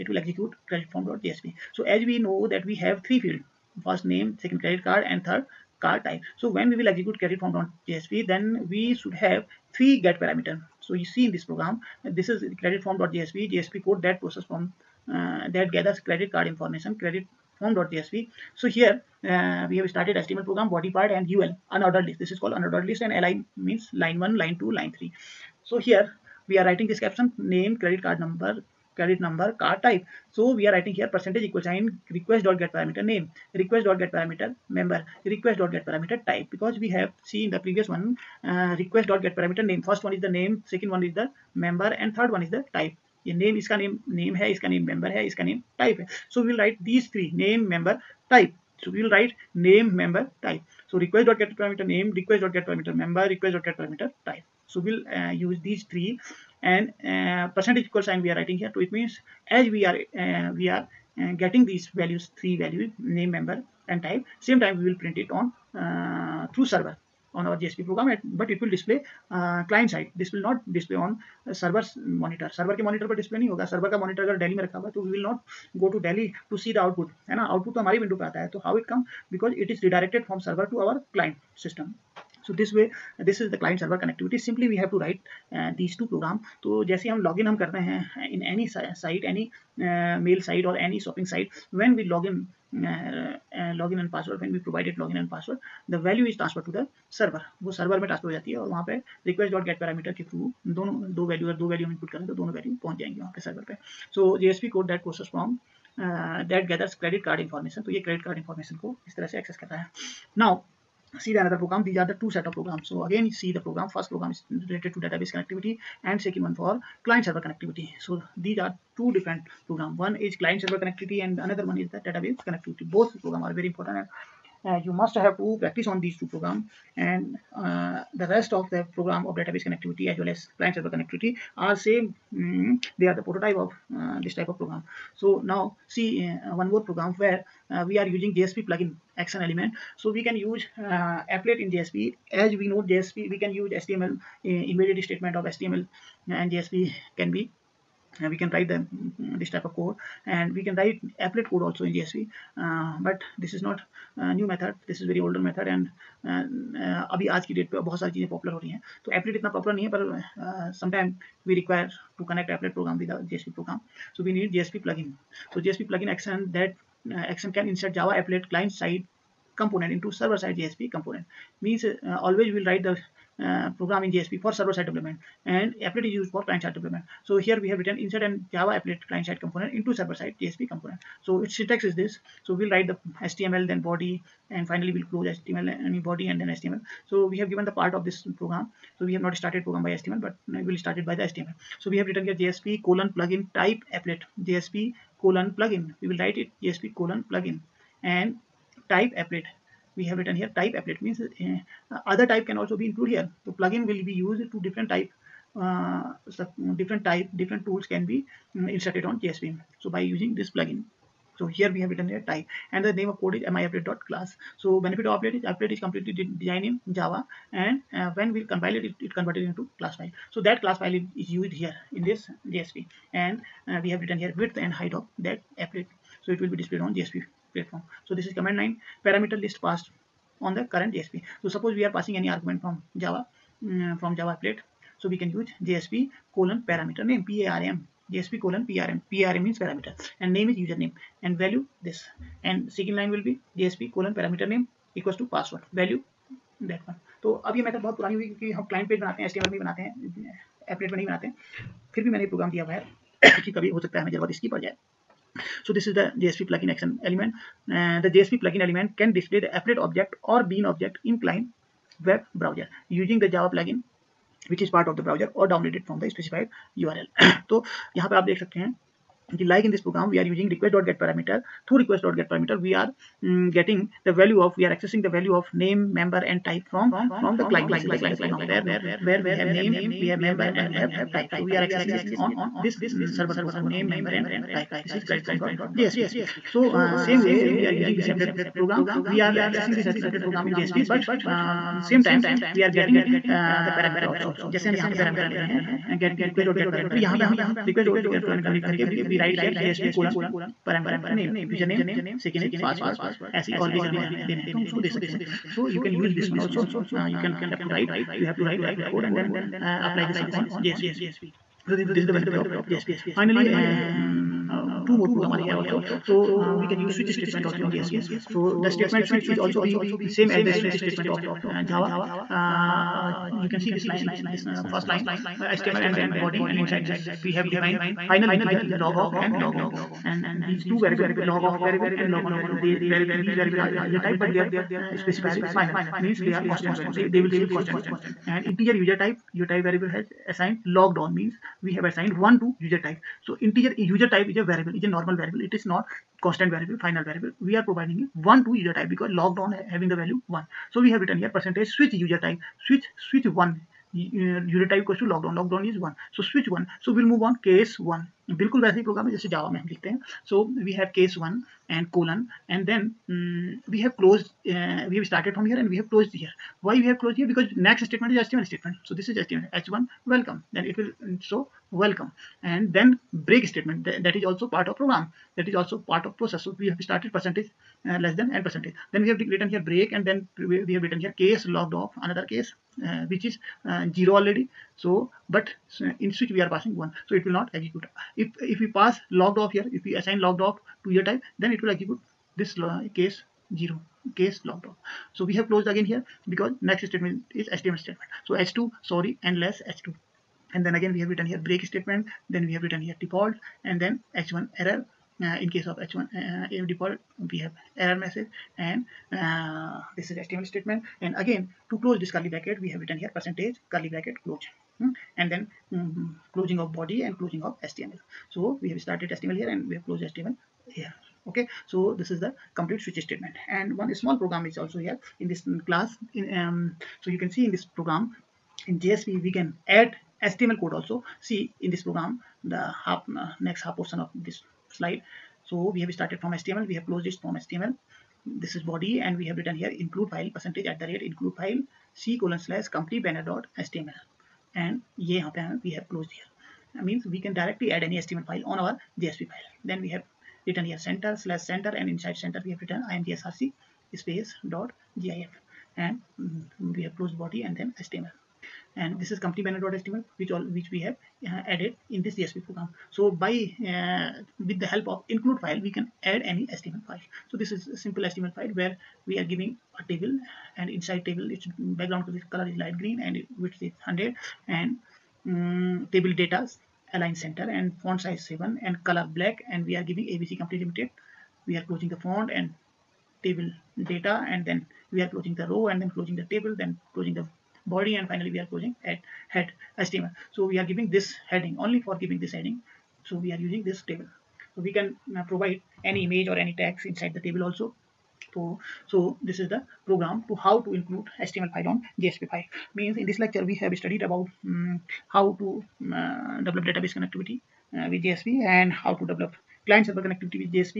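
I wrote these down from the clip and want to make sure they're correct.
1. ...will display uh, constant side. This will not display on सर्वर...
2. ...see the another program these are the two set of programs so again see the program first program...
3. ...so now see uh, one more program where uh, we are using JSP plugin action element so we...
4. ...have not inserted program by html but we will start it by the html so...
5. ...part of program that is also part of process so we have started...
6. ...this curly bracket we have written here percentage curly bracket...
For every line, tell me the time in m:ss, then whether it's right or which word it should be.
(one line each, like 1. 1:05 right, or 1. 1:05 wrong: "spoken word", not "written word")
1. 1:08 wrong: "client", not "constant"
2. 1:51 right
3. 2:15 right
4. 3:09 wrong: "started", not "inserted"
5. 6:14 right
6. 6:51 right.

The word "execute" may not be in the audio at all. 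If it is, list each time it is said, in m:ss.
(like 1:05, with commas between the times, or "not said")
0:00, 0:06, 6:27, 6:31.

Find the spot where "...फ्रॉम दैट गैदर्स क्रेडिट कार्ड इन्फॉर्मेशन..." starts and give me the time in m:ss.
1:45.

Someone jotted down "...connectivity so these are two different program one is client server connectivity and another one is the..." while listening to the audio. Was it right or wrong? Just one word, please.
right.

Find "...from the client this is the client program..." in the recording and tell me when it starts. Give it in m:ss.
4:37.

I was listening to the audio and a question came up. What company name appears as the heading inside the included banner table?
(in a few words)
ABC Company Limited.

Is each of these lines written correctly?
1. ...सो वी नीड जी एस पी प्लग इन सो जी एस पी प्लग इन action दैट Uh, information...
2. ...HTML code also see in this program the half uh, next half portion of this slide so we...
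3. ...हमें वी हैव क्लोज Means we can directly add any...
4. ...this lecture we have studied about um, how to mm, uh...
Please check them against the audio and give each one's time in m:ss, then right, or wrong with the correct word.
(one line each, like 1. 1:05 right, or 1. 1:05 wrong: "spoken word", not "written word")
1. 2:44 wrong: "action", not "information"
2. 7:10 right
3. 7:25 right
4. 8:23 right.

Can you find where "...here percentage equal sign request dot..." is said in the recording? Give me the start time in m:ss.
0:30.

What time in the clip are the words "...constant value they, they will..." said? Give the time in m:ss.
5:36.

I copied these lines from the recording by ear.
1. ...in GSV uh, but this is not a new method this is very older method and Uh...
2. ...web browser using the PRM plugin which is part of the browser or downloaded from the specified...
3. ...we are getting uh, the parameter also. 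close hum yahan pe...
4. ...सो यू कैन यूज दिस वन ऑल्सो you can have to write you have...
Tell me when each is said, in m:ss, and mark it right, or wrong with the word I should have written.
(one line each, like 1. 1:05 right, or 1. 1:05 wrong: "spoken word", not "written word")
1. 2:31 right
2. 4:22 wrong: "Java", not "PRM"
3. 4:52 wrong: "jaise", not "close"
4. 5:05 right.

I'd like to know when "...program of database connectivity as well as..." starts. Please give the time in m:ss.
2:08.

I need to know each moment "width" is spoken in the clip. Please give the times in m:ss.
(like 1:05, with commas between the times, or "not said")
3:44, 7:53.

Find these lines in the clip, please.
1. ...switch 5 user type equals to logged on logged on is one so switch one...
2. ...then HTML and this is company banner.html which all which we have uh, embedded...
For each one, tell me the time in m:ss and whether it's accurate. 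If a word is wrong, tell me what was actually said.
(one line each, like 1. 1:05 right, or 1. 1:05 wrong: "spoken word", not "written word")
1. 5:53 wrong: "1", not "5"
2. 7:37 wrong: "added", not "embedded".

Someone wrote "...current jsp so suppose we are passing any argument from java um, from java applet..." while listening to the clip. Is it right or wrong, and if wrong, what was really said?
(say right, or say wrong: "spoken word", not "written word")
right.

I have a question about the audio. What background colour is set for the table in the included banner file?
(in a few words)
light green.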